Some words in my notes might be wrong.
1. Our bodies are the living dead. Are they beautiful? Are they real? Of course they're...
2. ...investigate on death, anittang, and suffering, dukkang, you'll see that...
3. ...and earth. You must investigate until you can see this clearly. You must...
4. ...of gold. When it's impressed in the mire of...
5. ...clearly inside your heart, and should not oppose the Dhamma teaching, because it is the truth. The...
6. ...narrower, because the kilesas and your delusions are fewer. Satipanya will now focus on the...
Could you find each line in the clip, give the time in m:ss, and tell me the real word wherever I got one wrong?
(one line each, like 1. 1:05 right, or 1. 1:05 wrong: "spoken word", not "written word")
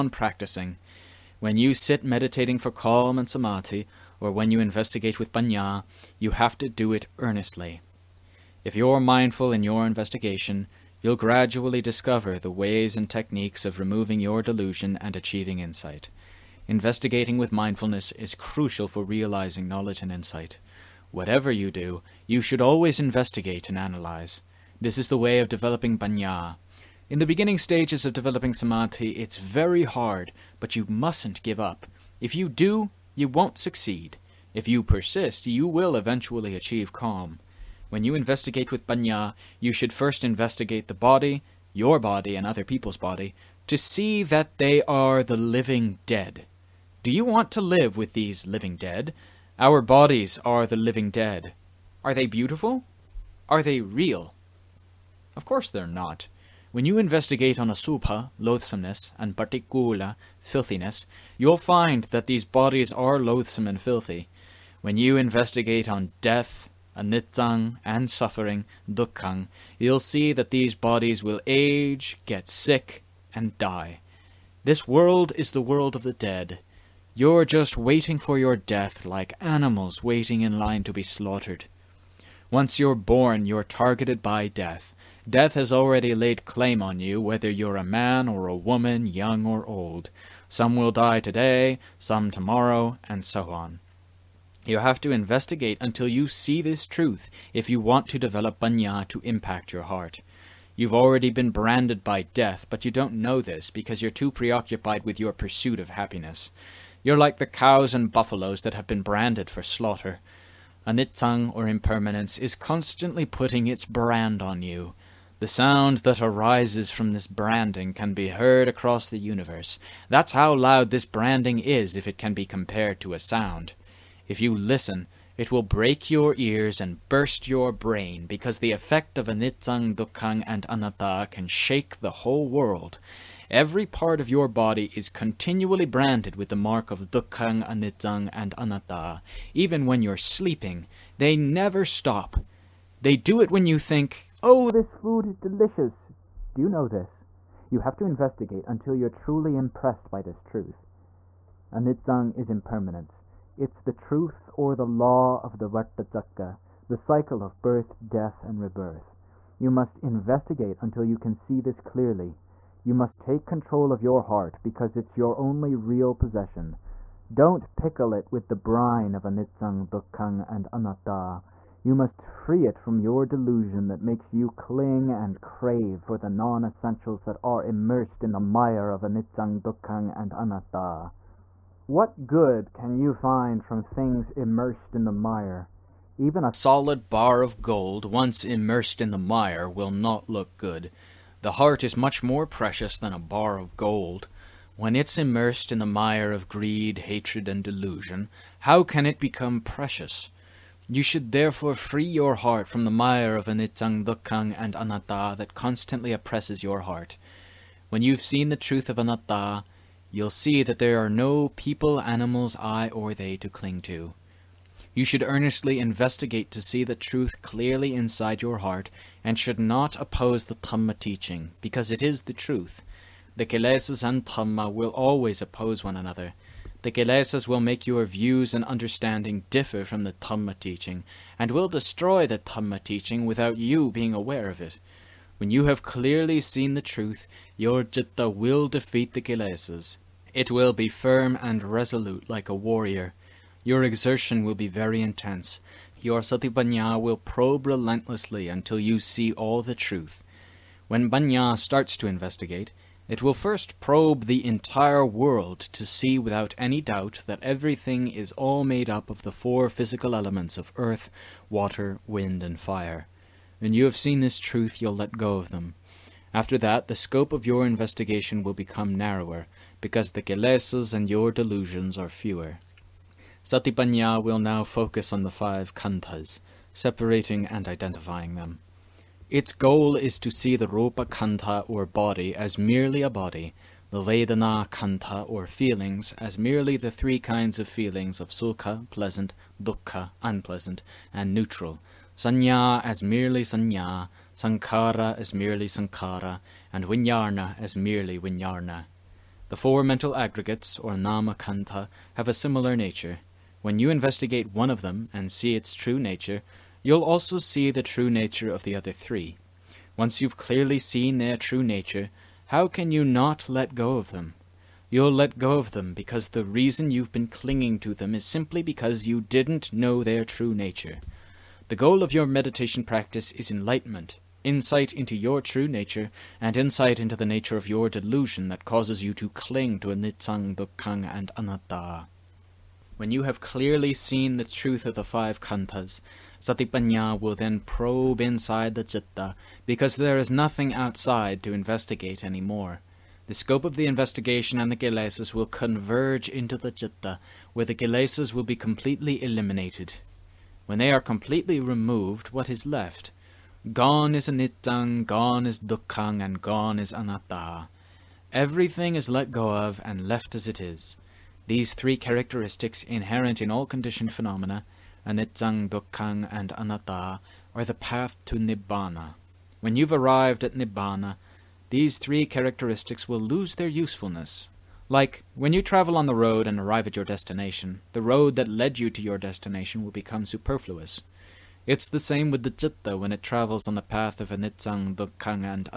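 1. 0:49 right
2. 1:05 right
3. 2:38 wrong: "rebirth", not "earth"
4. 3:13 wrong: "immersed", not "impressed"
5. 3:37 right
6. 4:28 right.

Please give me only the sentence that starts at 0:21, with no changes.
Whatever you do, you should always investigate and analyze.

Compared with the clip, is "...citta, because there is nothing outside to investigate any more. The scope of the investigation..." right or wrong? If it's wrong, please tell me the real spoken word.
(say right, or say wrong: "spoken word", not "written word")
right.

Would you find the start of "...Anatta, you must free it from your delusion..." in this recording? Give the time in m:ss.
2:50.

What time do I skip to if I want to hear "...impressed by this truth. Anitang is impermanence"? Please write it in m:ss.
2:29.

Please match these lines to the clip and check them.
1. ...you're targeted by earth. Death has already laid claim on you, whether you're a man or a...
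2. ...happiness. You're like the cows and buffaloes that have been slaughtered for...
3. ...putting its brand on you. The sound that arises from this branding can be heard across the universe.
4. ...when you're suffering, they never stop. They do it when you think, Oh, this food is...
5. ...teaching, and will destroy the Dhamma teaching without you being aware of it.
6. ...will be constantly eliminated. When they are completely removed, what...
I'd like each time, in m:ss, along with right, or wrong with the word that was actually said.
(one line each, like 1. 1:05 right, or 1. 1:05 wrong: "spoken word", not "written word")
1. 1:23 wrong: "death", not "earth"
2. 1:45 wrong: "branded", not "slaughtered"
3. 1:53 right
4. 2:19 wrong: "sleeping", not "suffering"
5. 3:50 right
6. 5:48 wrong: "completely", not "constantly".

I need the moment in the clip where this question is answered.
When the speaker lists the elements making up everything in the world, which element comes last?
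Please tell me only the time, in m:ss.
4:22.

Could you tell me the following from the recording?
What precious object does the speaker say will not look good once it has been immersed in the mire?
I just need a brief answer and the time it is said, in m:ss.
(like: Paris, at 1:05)
a solid bar of gold, at 3:06.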